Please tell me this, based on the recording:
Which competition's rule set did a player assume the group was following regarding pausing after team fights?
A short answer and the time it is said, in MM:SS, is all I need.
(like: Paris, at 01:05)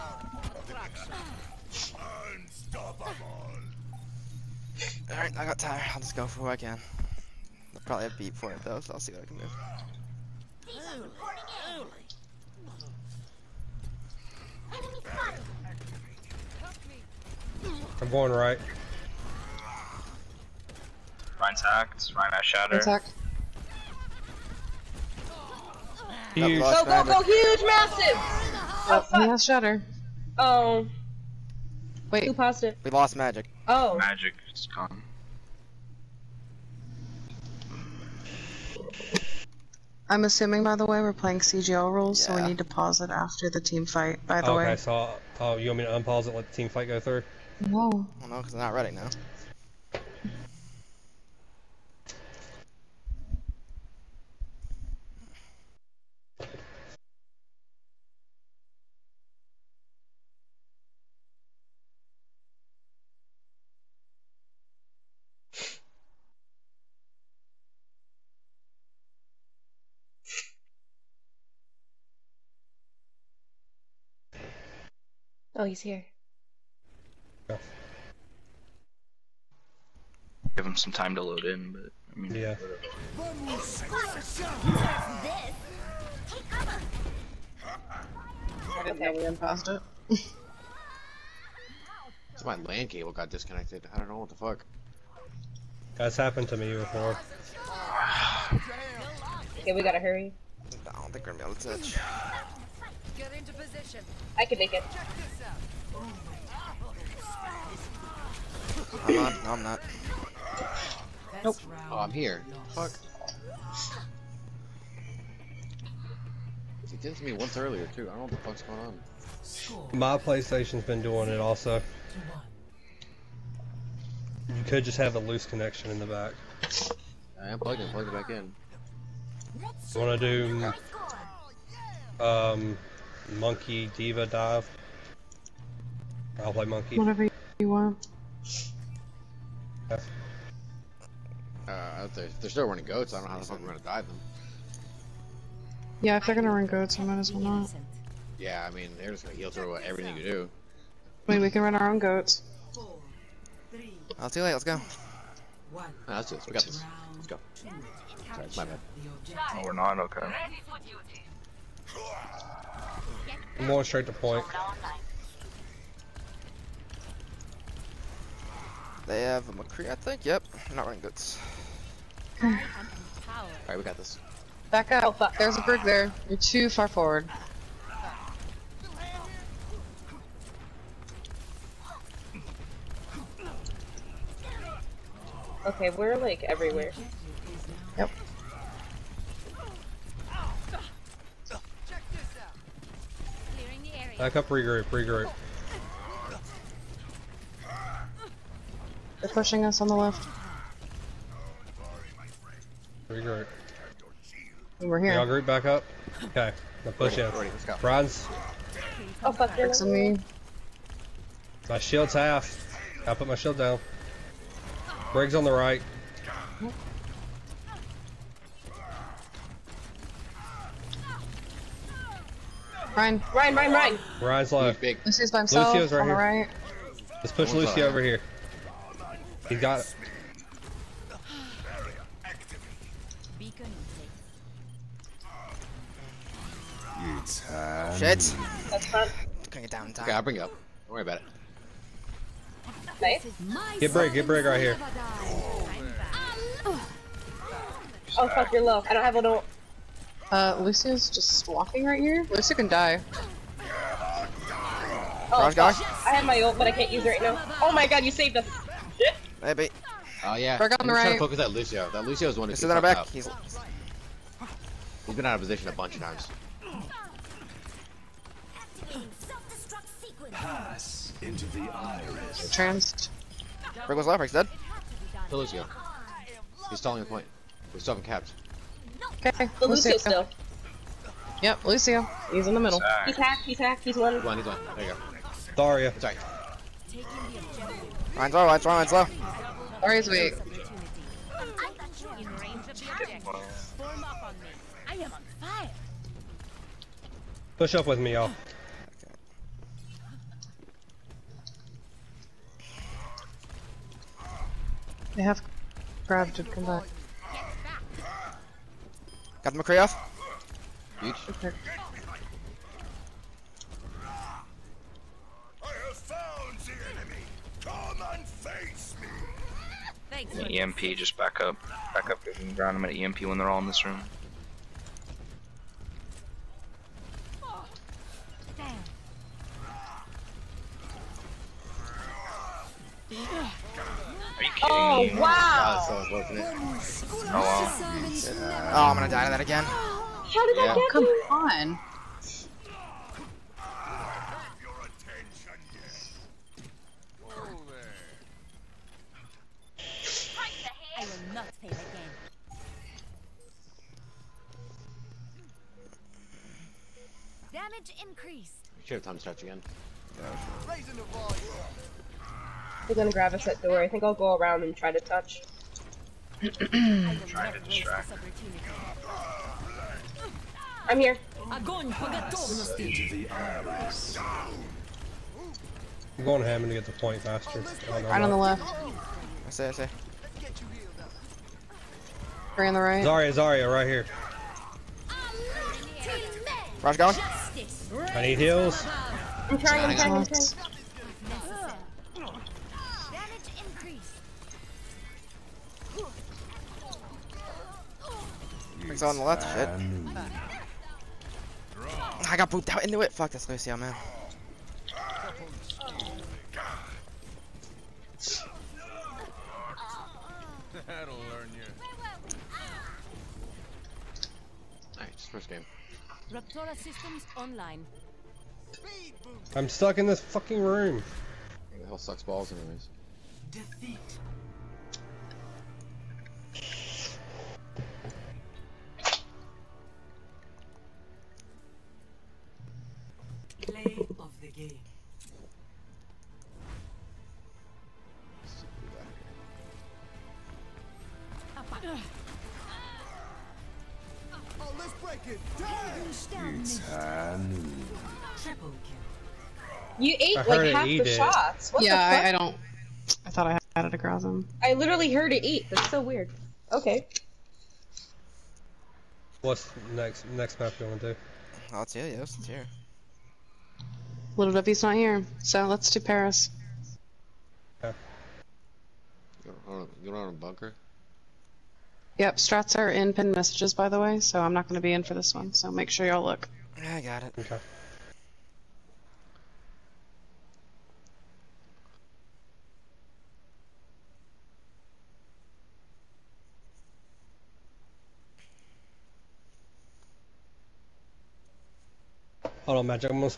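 CGL, at 00:41.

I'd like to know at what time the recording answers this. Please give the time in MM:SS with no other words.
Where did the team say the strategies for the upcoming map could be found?
07:53.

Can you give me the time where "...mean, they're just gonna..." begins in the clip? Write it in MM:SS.
02:28.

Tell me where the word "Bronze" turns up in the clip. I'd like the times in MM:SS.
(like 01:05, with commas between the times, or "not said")
03:27.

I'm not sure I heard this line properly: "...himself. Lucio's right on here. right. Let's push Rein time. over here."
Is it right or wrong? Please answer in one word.
wrong.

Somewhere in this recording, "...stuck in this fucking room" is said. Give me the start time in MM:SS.
06:59.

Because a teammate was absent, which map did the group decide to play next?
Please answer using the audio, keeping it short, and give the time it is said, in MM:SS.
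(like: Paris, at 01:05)
Paris, at 07:46.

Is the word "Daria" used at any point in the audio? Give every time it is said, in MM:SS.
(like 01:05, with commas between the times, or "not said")
04:45, 04:49.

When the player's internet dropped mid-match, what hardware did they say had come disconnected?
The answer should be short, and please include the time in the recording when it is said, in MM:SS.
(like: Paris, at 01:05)
land cable, at 01:32.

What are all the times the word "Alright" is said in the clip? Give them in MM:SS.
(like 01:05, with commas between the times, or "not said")
00:05, 02:52, 06:54.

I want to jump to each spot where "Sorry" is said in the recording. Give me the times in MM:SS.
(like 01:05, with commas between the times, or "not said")
02:37, 04:42.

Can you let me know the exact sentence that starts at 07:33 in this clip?
I thought I had it across him.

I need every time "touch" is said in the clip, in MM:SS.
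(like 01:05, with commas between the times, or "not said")
01:41, 06:05.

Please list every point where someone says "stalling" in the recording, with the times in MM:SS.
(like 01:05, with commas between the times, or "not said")
04:36.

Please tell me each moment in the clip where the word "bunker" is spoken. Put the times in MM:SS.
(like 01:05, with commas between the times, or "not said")
07:50.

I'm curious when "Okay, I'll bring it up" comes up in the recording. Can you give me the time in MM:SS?
04:00.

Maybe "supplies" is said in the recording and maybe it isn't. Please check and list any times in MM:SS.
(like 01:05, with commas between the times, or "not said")
not said.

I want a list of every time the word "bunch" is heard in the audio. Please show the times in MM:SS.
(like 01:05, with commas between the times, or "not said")
04:25.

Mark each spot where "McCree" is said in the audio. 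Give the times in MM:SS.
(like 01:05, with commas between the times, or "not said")
02:49, 05:09.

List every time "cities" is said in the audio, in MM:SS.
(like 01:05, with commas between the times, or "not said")
not said.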